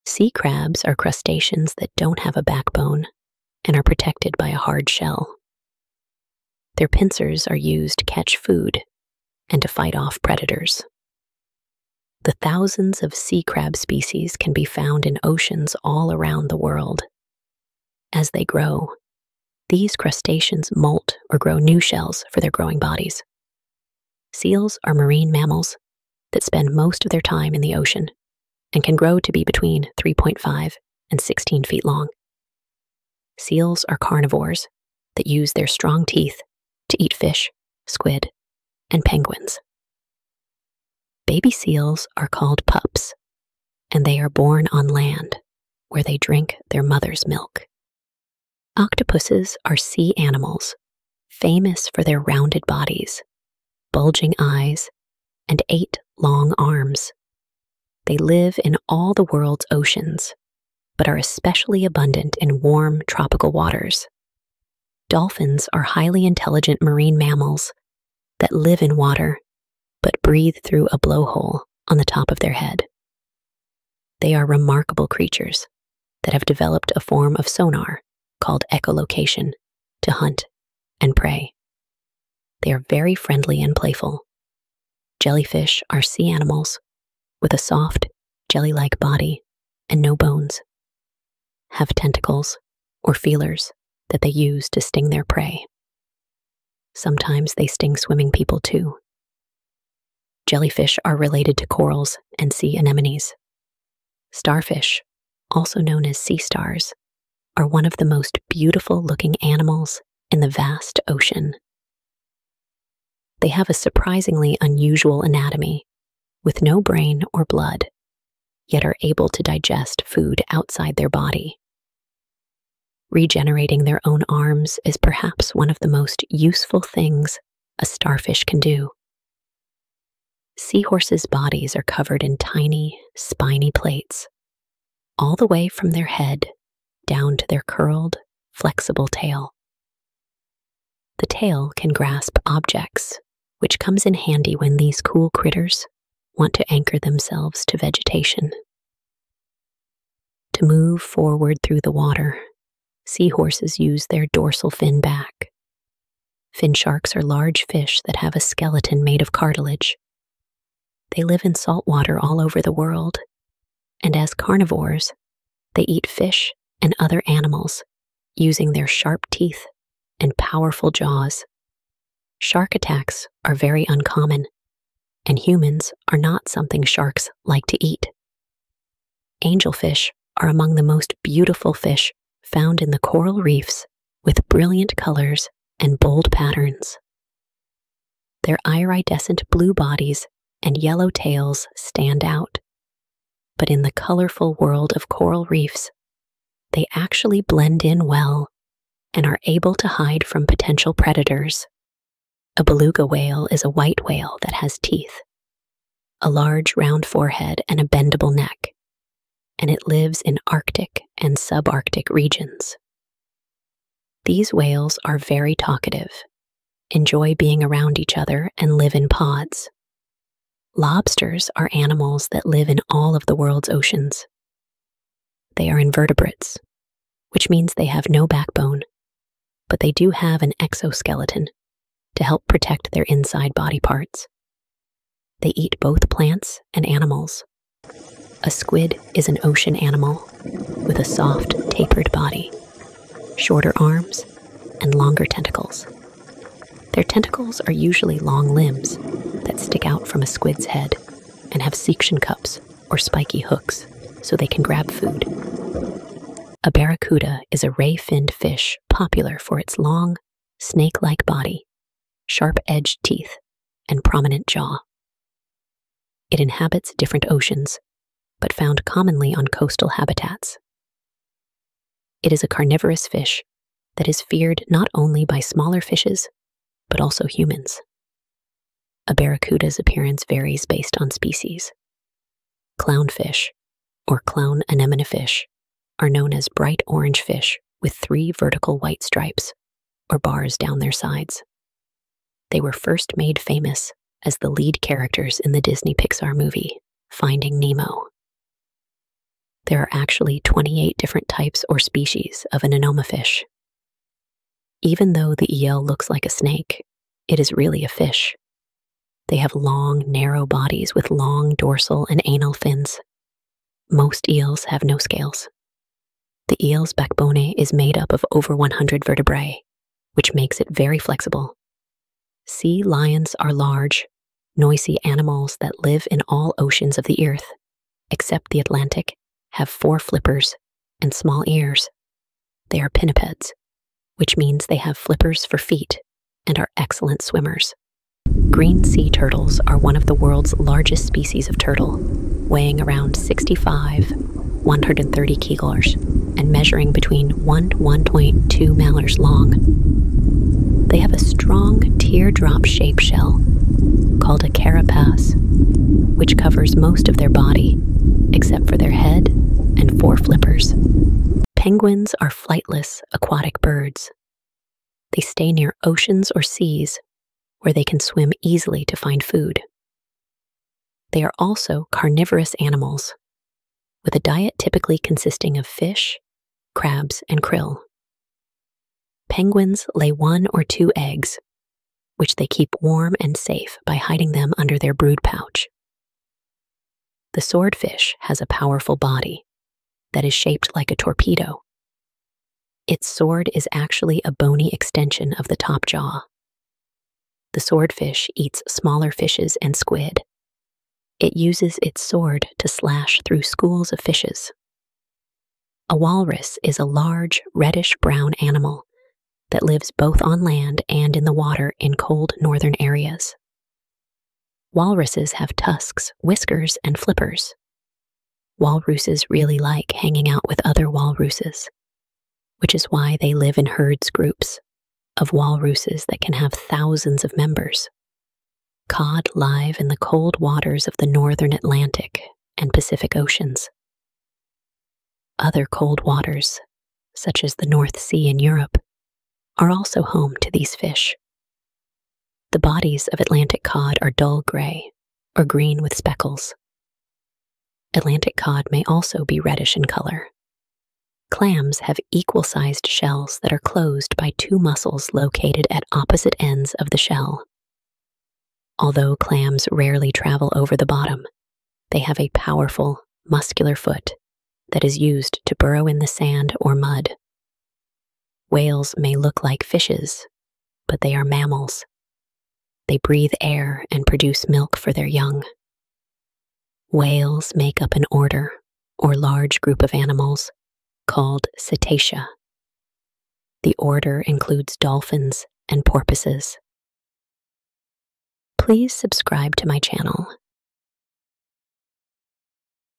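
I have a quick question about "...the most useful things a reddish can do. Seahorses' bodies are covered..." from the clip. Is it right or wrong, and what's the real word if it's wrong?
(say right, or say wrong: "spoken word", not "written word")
wrong: "starfish", not "reddish".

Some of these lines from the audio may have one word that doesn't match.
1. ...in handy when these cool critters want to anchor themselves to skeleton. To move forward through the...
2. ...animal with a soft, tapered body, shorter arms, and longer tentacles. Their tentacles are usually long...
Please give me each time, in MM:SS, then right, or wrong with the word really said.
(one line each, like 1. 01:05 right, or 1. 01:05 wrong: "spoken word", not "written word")
1. 02:24 wrong: "vegetation", not "skeleton"
2. 03:59 right.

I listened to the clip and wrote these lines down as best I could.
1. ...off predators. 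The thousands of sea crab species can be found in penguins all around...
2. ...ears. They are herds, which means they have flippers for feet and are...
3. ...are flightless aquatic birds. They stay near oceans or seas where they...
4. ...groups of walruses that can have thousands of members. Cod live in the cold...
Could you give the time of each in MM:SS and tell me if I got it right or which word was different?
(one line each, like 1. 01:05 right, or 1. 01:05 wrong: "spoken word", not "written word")
1. 00:09 wrong: "oceans", not "penguins"
2. 05:31 wrong: "pinnipeds", not "herds"
3. 06:02 right
4. 07:04 right.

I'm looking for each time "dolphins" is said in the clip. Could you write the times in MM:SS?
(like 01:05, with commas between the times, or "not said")
01:05, 08:04.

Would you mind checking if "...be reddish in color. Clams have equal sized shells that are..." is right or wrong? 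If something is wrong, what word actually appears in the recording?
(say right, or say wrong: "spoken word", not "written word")
right.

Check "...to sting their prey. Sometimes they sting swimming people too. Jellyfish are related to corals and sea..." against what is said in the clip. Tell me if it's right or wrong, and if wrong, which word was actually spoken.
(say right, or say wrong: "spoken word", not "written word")
right.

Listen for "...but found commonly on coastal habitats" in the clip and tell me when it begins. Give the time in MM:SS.
04:28.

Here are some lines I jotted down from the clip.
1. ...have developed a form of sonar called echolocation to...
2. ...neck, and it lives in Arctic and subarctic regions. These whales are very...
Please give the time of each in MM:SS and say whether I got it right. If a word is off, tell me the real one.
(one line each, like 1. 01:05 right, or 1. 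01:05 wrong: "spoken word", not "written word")
1. 01:16 right
2. 03:28 right.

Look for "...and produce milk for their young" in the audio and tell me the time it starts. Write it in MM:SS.
07:53.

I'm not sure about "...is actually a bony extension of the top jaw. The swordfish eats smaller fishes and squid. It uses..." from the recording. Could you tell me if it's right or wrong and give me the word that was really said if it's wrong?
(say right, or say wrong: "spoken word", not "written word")
right.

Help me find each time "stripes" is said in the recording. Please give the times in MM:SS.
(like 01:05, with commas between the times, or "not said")
04:49.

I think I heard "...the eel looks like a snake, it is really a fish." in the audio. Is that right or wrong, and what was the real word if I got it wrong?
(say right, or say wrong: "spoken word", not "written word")
right.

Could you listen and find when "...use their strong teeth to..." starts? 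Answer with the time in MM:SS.
00:35.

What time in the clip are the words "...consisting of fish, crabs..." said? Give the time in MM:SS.
06:14.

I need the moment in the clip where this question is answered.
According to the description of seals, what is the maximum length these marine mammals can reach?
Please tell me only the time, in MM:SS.
00:31.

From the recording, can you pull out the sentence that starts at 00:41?
Baby seals are called pups, and they are born on land where they drink their mother's milk.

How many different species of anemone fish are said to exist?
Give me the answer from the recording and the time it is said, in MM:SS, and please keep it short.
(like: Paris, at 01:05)
28, at 05:00.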